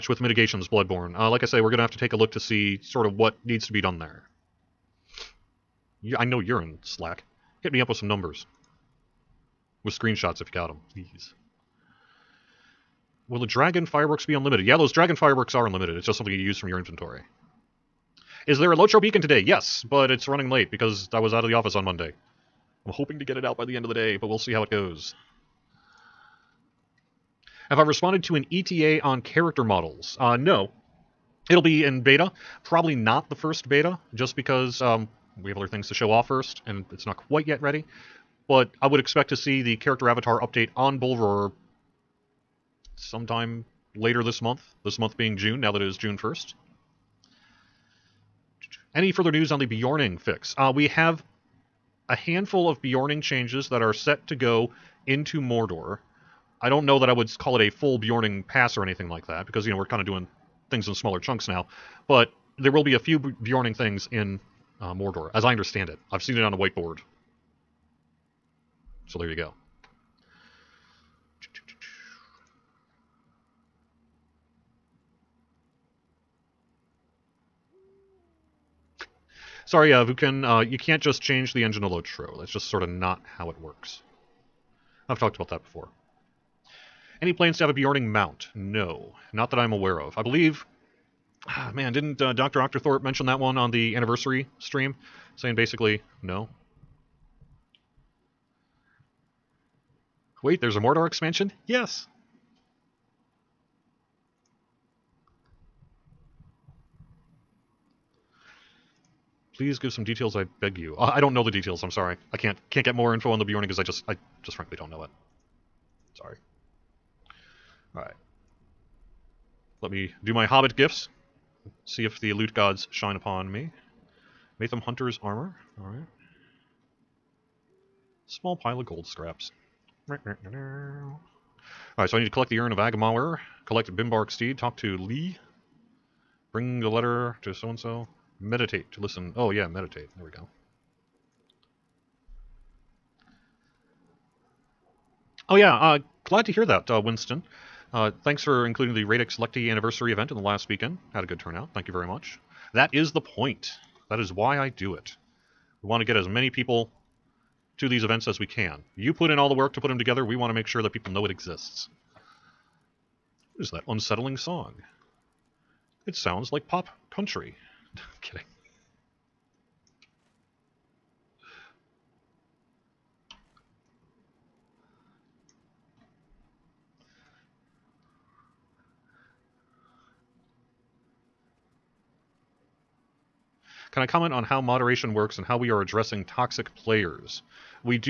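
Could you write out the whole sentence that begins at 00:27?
Have I responded to an ETA on character models?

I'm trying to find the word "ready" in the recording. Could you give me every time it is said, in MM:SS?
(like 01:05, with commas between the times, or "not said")
00:37.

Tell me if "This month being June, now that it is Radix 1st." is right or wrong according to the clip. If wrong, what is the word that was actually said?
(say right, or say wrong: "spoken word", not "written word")
wrong: "June", not "Radix".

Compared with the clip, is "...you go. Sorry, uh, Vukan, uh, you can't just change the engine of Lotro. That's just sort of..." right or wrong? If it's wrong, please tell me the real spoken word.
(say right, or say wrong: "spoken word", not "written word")
right.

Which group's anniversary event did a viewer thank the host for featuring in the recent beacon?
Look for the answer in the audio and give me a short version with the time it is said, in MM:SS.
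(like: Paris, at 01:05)
Radix Lecti, at 02:29.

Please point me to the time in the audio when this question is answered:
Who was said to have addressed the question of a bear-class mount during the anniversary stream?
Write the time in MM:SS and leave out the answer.
01:32.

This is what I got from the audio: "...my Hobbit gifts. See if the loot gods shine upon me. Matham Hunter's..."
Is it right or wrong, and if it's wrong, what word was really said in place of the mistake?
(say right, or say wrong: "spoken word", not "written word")
right.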